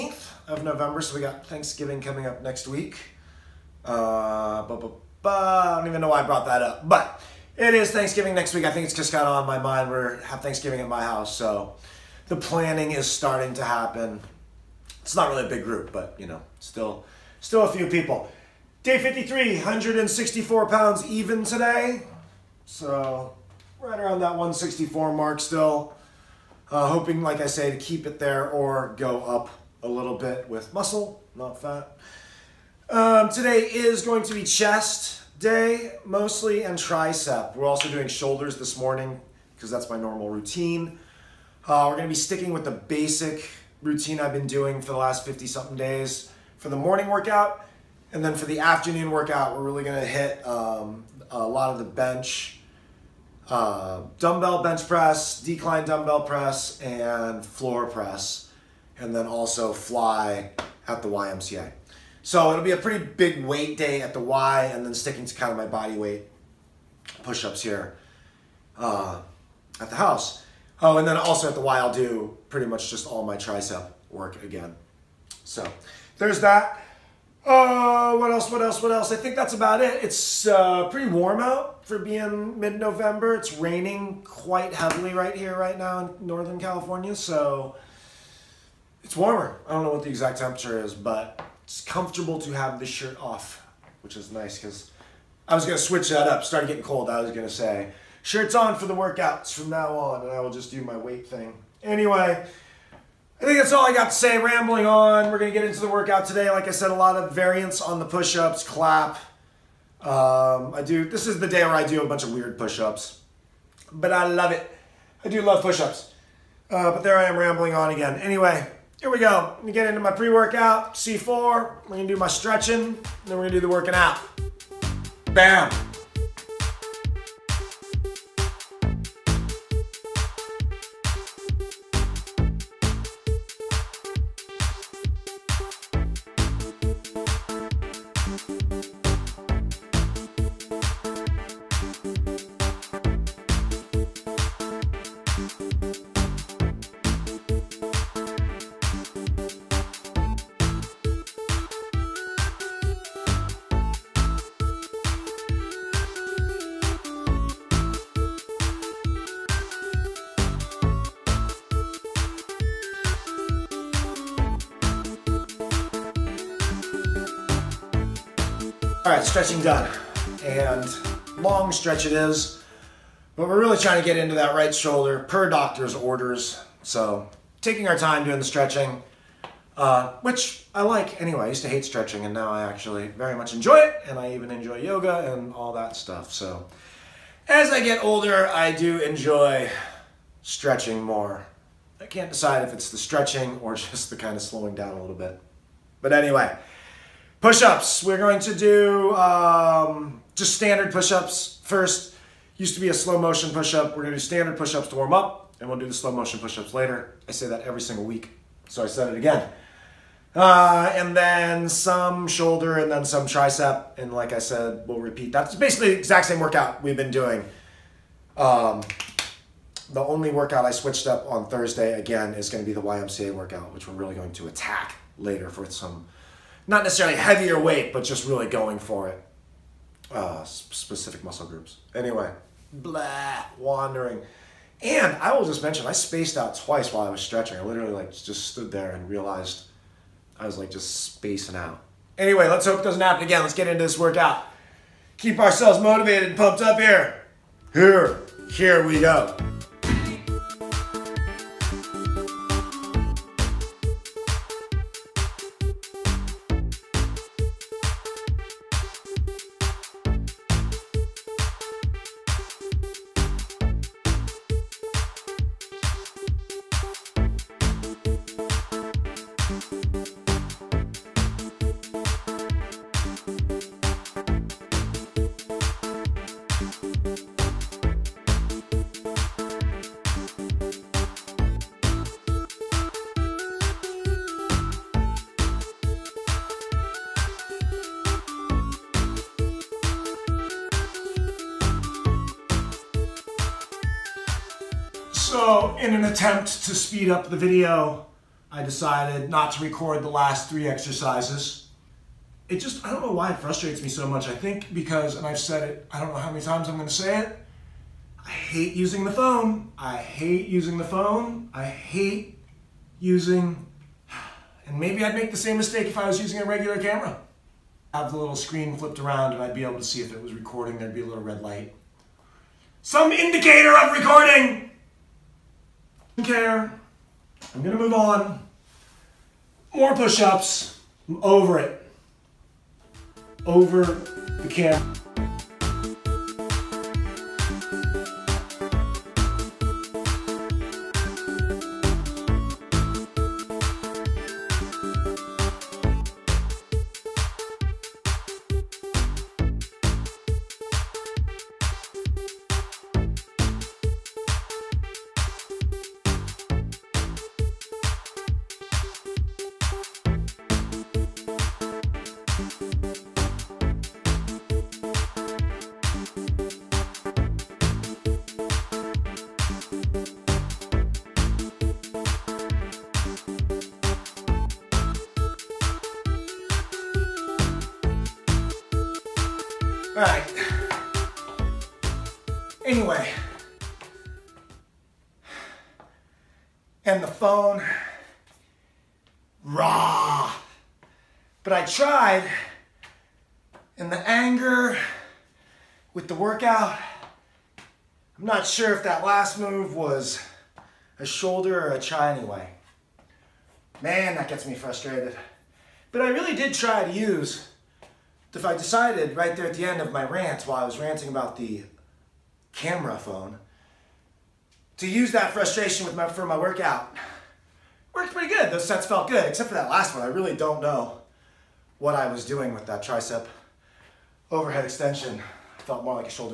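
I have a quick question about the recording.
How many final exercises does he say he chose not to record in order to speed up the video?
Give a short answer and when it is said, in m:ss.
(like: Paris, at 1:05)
3, at 5:00.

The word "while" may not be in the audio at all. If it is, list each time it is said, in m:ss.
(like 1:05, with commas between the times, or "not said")
3:56, 6:50.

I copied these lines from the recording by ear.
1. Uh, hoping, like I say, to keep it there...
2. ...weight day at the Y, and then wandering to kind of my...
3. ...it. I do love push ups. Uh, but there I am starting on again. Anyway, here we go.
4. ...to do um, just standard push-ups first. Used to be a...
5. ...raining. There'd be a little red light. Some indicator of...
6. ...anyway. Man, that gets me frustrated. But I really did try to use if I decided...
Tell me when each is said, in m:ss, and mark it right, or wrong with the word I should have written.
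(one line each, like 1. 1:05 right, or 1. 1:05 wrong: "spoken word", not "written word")
1. 0:26 right
2. 1:03 wrong: "sticking", not "wandering"
3. 1:54 wrong: "rambling", not "starting"
4. 3:18 right
5. 5:20 wrong: "recording", not "raining"
6. 6:42 right.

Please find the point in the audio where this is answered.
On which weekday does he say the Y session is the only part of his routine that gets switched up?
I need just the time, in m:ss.
3:41.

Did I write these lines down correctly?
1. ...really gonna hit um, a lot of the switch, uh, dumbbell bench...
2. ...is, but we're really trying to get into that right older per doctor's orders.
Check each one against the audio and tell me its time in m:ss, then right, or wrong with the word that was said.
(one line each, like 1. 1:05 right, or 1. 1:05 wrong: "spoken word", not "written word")
1. 0:49 wrong: "bench", not "switch"
2. 2:52 wrong: "shoulder", not "older".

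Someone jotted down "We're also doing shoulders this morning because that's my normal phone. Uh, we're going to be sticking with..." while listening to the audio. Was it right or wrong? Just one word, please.
wrong.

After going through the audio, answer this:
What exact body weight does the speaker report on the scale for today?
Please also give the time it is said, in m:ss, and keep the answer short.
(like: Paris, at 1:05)
164 pounds, at 0:19.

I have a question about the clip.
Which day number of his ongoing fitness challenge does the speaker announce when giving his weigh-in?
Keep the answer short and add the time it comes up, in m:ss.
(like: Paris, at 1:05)
53, at 0:18.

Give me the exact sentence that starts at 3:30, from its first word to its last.
Uh, and then some shoulder and then some tricep.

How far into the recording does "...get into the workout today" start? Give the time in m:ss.
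1:45.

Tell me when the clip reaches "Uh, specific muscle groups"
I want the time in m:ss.
3:50.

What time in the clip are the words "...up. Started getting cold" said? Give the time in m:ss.
1:36.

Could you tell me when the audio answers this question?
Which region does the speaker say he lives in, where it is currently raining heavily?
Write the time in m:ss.
1:26.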